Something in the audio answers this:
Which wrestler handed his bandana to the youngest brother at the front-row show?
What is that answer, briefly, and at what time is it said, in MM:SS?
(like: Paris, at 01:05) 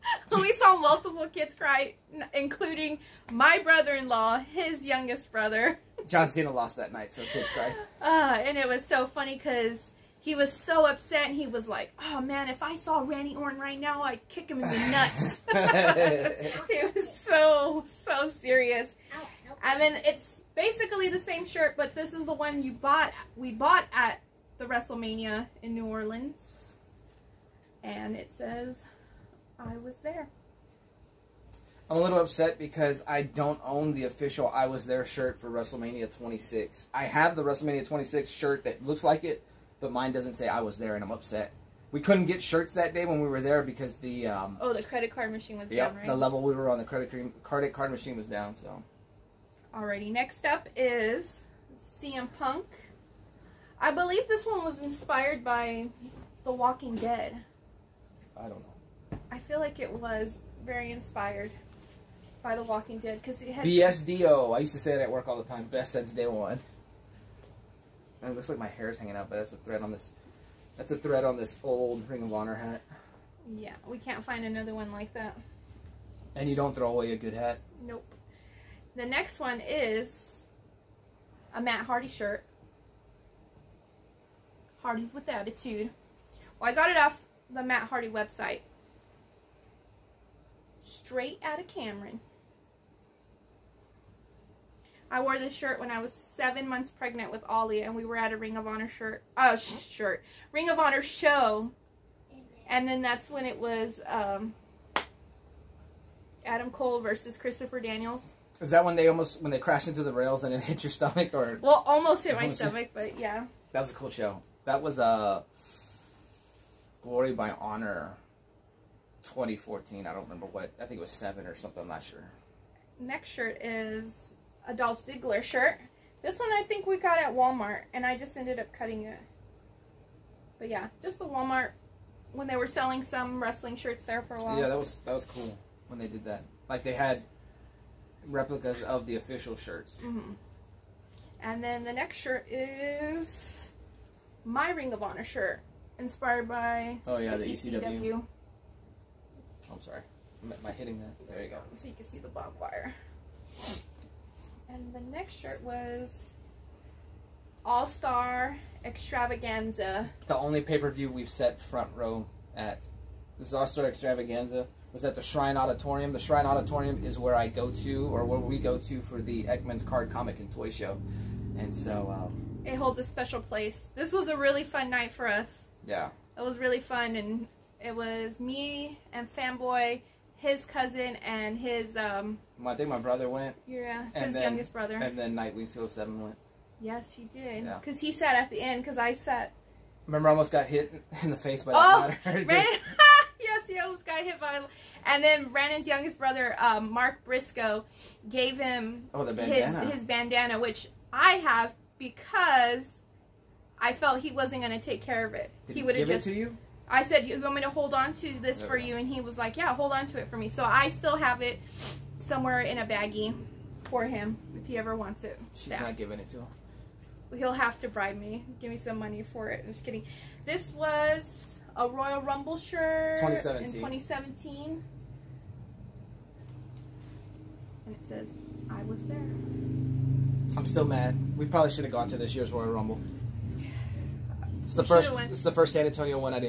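Mark Briscoe, at 03:16.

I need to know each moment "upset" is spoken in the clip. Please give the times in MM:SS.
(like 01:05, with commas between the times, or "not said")
00:10, 00:32, 00:41.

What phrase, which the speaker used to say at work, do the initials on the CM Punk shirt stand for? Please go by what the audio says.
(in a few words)
Best since day one.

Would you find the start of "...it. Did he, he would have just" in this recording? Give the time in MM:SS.
03:25.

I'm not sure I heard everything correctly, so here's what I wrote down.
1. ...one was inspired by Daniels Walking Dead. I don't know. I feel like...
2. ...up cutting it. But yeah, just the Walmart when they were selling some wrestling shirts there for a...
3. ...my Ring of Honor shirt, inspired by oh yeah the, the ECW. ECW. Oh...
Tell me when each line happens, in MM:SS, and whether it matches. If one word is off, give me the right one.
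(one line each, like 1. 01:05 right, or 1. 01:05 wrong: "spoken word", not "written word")
1. 00:54 wrong: "The", not "Daniels"
2. 02:08 right
3. 02:24 right.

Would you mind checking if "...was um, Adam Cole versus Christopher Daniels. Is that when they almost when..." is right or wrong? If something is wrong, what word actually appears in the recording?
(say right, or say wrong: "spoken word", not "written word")
right.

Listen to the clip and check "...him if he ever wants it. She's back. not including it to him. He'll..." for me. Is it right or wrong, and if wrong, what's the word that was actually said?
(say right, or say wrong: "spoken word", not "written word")
wrong: "giving", not "including".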